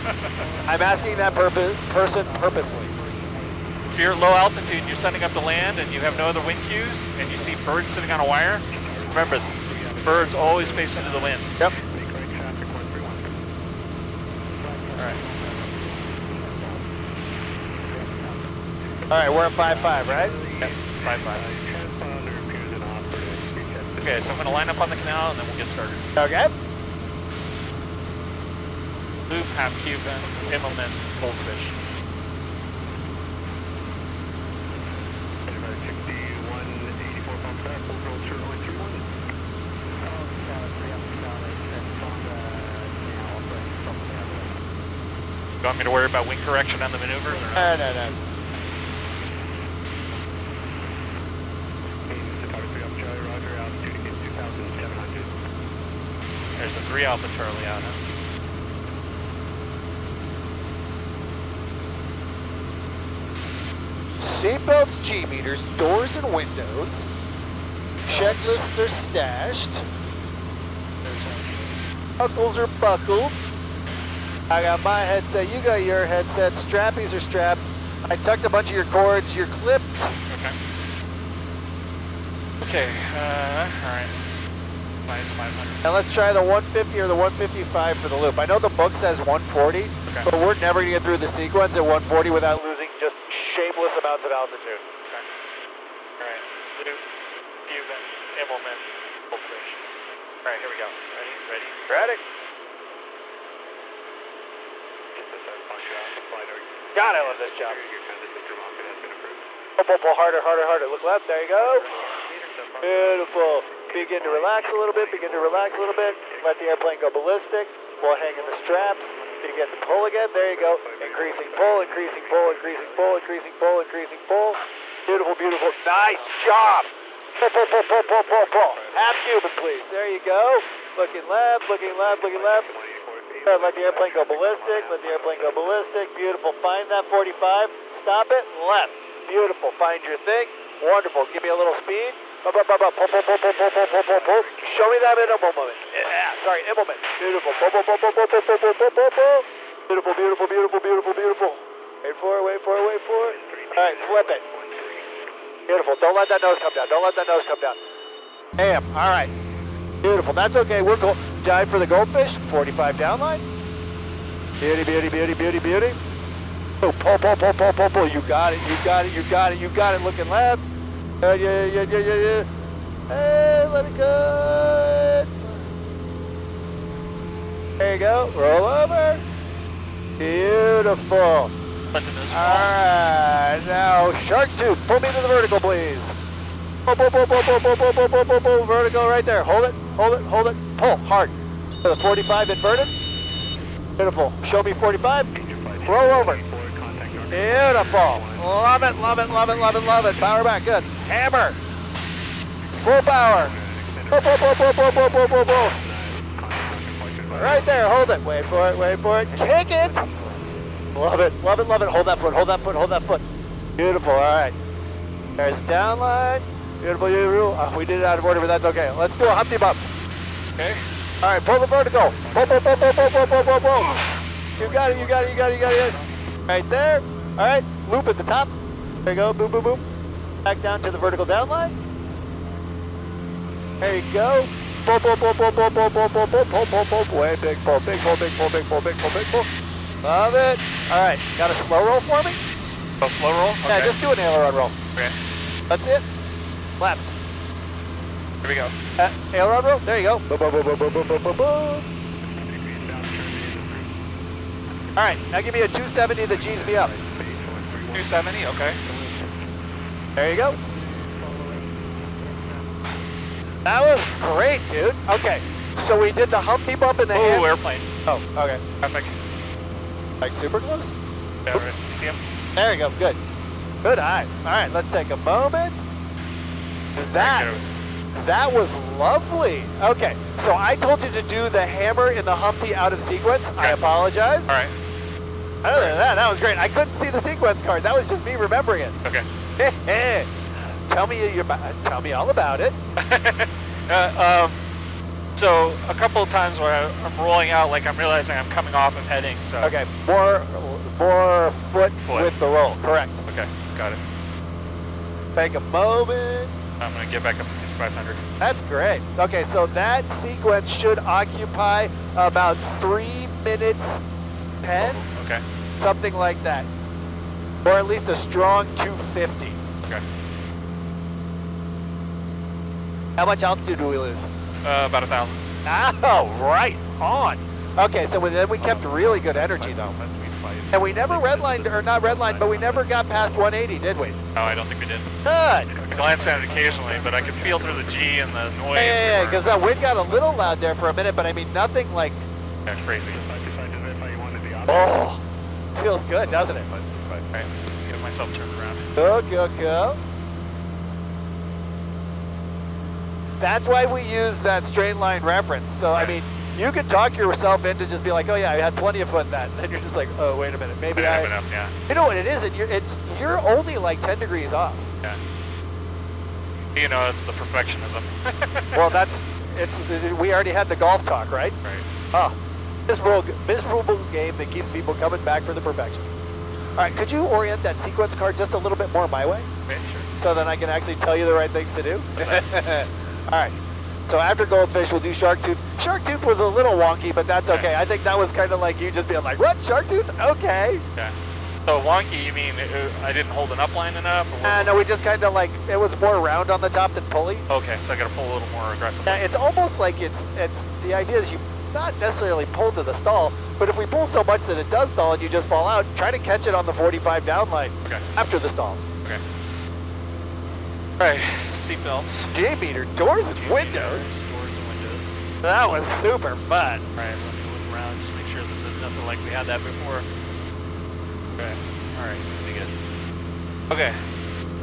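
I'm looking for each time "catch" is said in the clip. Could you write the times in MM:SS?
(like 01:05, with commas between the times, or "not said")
06:46.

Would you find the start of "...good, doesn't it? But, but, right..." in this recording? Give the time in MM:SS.
05:46.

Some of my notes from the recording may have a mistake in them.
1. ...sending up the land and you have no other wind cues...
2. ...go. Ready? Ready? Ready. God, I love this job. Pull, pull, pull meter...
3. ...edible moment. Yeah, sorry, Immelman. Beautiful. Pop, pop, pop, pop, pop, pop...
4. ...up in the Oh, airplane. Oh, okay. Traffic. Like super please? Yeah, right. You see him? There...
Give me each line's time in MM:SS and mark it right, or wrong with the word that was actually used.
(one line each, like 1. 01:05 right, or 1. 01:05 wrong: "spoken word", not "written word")
1. 00:04 right
2. 01:40 wrong: "harder", not "meter"
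3. 02:25 right
4. 04:26 wrong: "close", not "please".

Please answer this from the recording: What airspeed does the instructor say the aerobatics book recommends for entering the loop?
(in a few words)
140.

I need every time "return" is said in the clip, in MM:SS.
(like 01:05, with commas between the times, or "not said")
not said.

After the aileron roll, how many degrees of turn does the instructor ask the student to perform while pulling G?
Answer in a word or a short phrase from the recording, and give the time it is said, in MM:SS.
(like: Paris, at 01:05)
270, at 04:15.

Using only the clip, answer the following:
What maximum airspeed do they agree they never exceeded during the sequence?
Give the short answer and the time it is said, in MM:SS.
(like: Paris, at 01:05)
180, at 05:32.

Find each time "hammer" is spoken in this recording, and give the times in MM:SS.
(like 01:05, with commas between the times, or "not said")
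03:21, 04:41.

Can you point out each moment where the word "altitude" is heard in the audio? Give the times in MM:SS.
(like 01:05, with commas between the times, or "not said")
00:04, 01:34, 05:23.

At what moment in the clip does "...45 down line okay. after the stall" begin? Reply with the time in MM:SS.
06:46.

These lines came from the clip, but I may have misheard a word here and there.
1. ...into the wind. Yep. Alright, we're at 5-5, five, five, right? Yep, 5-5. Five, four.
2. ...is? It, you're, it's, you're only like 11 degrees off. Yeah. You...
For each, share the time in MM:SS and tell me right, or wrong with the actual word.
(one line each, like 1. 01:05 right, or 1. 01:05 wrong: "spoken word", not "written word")
1. 00:10 wrong: "five", not "four"
2. 06:02 wrong: "10", not "11".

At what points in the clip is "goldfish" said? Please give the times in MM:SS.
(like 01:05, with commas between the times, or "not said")
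00:31, 02:41, 06:24.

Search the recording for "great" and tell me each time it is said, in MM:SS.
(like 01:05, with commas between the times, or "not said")
04:24, 04:46, 05:08.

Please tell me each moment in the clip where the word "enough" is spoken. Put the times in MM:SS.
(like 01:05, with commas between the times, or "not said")
06:01, 06:33.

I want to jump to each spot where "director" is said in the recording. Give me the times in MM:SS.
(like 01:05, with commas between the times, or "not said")
not said.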